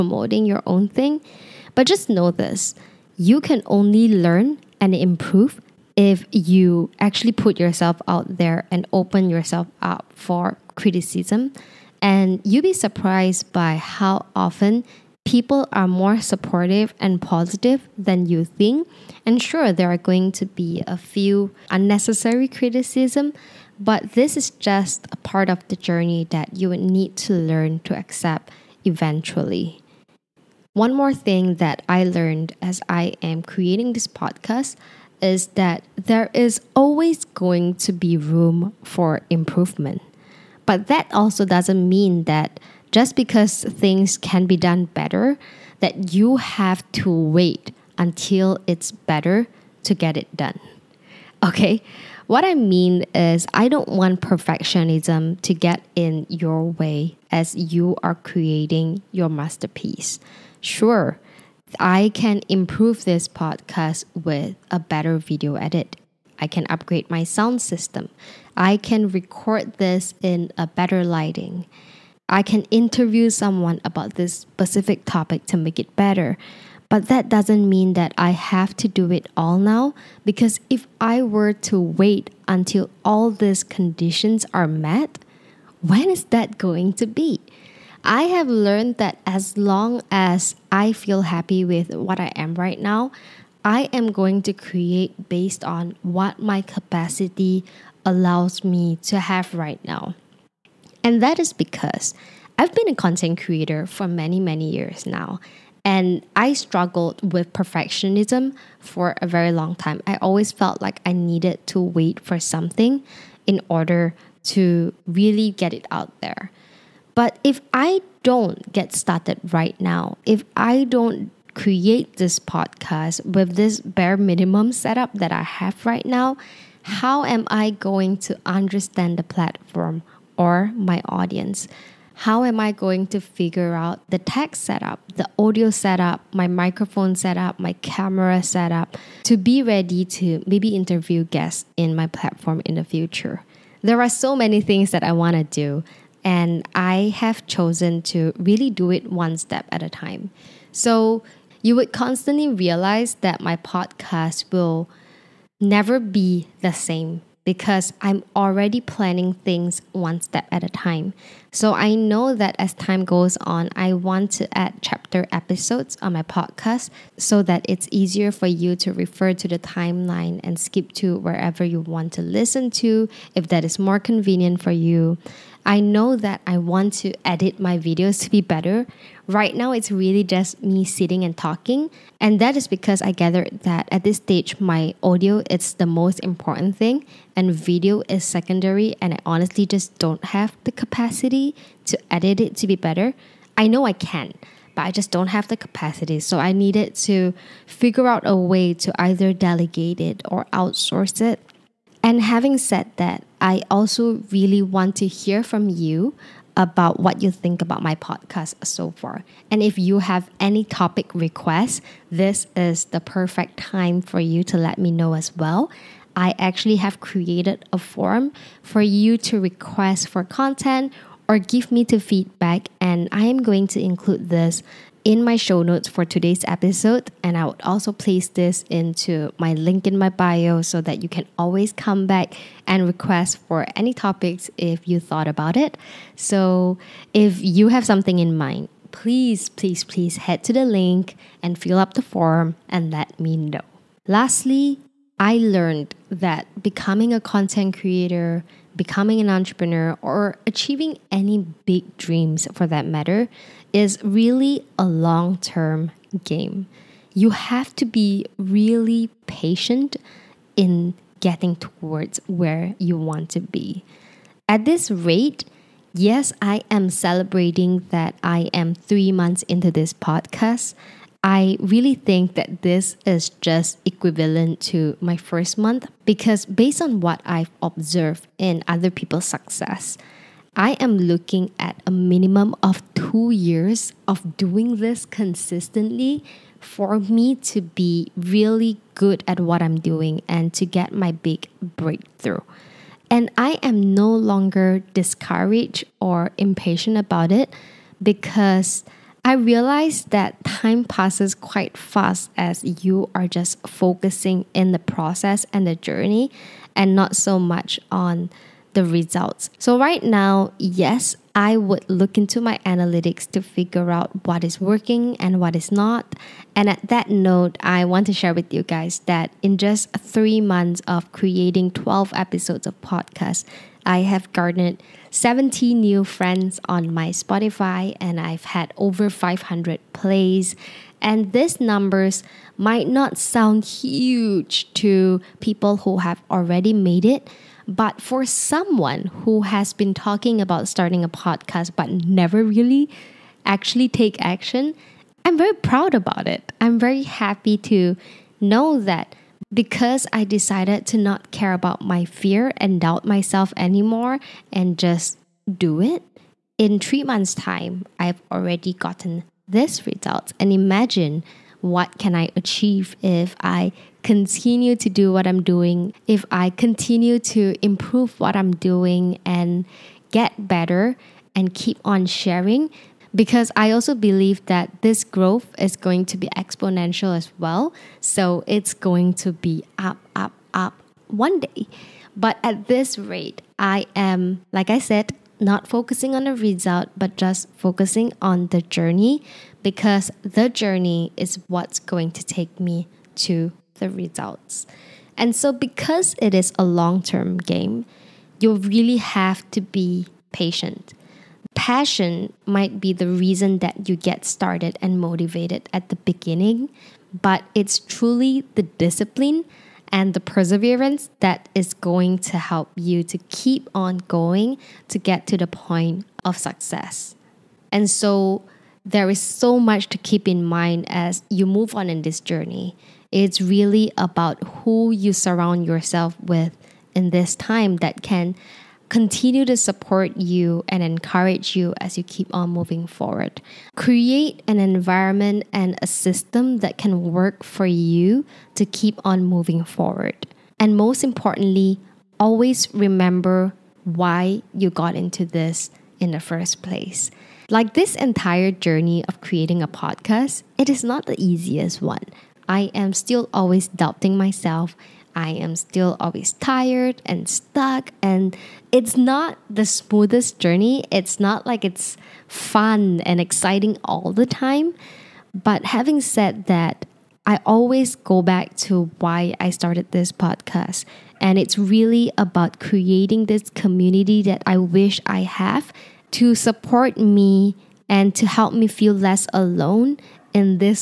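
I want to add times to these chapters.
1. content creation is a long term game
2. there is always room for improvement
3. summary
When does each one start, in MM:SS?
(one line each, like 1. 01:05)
1. 04:03
2. 00:30
3. 07:20.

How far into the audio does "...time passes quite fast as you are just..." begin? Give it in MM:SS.
05:00.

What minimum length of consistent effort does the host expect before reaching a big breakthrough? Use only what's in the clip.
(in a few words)
2 years.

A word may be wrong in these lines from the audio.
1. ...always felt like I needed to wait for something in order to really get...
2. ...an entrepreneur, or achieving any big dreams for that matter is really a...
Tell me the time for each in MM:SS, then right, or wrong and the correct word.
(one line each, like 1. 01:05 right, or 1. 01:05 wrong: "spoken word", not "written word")
1. 01:50 right
2. 04:09 right.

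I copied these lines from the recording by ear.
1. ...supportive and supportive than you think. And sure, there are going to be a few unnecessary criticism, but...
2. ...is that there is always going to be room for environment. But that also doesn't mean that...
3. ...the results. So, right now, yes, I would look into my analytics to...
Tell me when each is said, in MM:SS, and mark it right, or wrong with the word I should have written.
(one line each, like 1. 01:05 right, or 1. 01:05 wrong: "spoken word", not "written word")
1. 00:16 wrong: "positive", not "supportive"
2. 00:35 wrong: "improvement", not "environment"
3. 05:08 right.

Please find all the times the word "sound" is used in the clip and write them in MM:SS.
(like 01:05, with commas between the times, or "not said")
01:07, 05:33.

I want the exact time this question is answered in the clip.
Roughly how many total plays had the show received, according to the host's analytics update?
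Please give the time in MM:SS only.
05:28.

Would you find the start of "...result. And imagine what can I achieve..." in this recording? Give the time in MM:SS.
05:59.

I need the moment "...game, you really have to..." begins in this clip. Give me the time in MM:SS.
06:37.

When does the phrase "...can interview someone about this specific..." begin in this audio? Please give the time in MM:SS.
01:12.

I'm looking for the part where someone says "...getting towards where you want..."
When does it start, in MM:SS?
04:21.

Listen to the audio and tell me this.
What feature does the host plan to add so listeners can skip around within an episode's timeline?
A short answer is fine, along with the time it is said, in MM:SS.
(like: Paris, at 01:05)
chapter episodes, at 02:44.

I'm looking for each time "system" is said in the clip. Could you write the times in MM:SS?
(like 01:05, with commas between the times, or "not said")
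01:07, 07:15.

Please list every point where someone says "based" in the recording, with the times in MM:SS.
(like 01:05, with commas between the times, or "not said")
01:35, 04:36.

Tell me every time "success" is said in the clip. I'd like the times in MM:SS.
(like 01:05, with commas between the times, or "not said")
04:39, 06:56.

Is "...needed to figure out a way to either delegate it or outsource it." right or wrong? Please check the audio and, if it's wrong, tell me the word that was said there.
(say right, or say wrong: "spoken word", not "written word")
right.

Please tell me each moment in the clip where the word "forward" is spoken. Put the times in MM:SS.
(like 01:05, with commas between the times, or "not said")
07:12, 07:19.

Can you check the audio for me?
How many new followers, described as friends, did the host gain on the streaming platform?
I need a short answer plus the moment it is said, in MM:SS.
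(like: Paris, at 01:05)
70, at 05:25.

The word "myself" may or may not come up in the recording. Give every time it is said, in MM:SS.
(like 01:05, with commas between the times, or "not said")
05:53, 07:34.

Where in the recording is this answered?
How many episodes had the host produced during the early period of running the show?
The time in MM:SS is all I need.
05:21.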